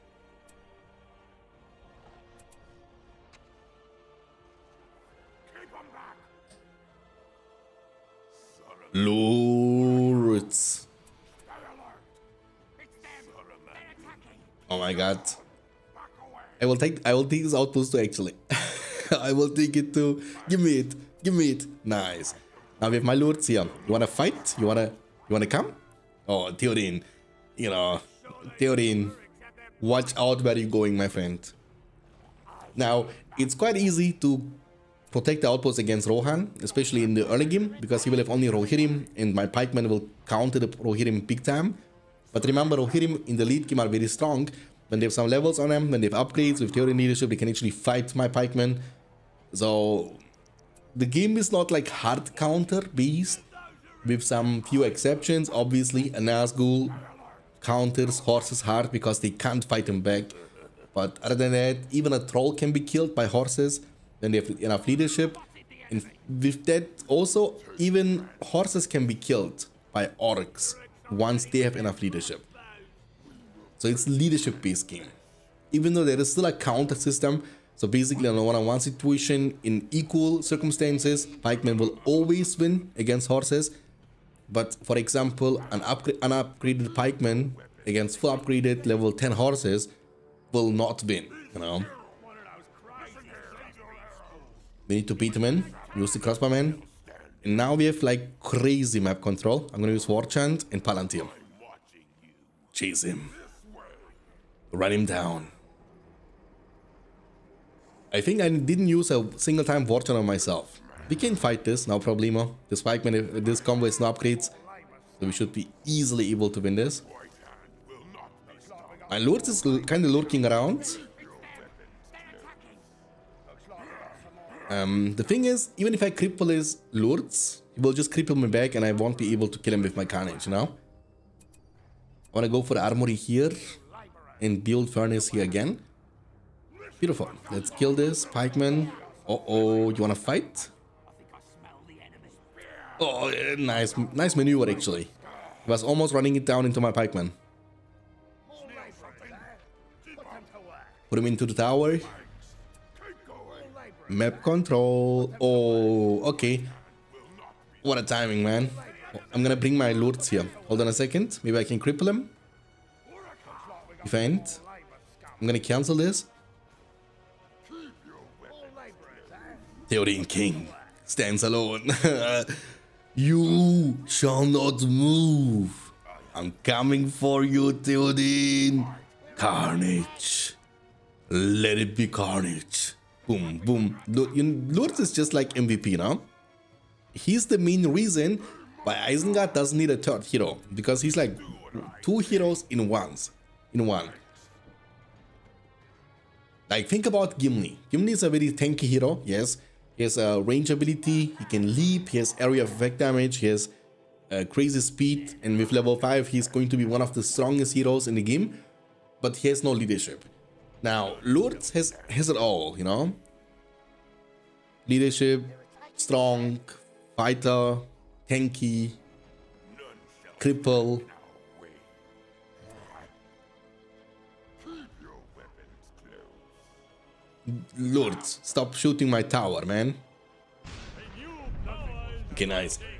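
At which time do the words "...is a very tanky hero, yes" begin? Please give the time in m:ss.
3:18.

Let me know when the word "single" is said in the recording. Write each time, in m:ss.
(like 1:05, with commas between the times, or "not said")
1:49.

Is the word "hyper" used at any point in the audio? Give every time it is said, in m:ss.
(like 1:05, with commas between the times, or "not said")
not said.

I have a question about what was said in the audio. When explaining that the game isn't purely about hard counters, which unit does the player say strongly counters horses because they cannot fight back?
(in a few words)
Nazgul.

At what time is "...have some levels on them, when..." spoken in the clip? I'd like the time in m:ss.
0:45.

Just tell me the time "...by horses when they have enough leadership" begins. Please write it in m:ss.
1:03.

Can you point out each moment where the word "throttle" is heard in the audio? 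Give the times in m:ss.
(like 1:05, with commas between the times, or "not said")
not said.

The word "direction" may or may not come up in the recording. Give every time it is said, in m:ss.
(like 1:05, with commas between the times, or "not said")
not said.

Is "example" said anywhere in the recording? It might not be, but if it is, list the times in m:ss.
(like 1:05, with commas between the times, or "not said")
1:24.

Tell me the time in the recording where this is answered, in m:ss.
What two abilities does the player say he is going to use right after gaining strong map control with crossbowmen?
1:40.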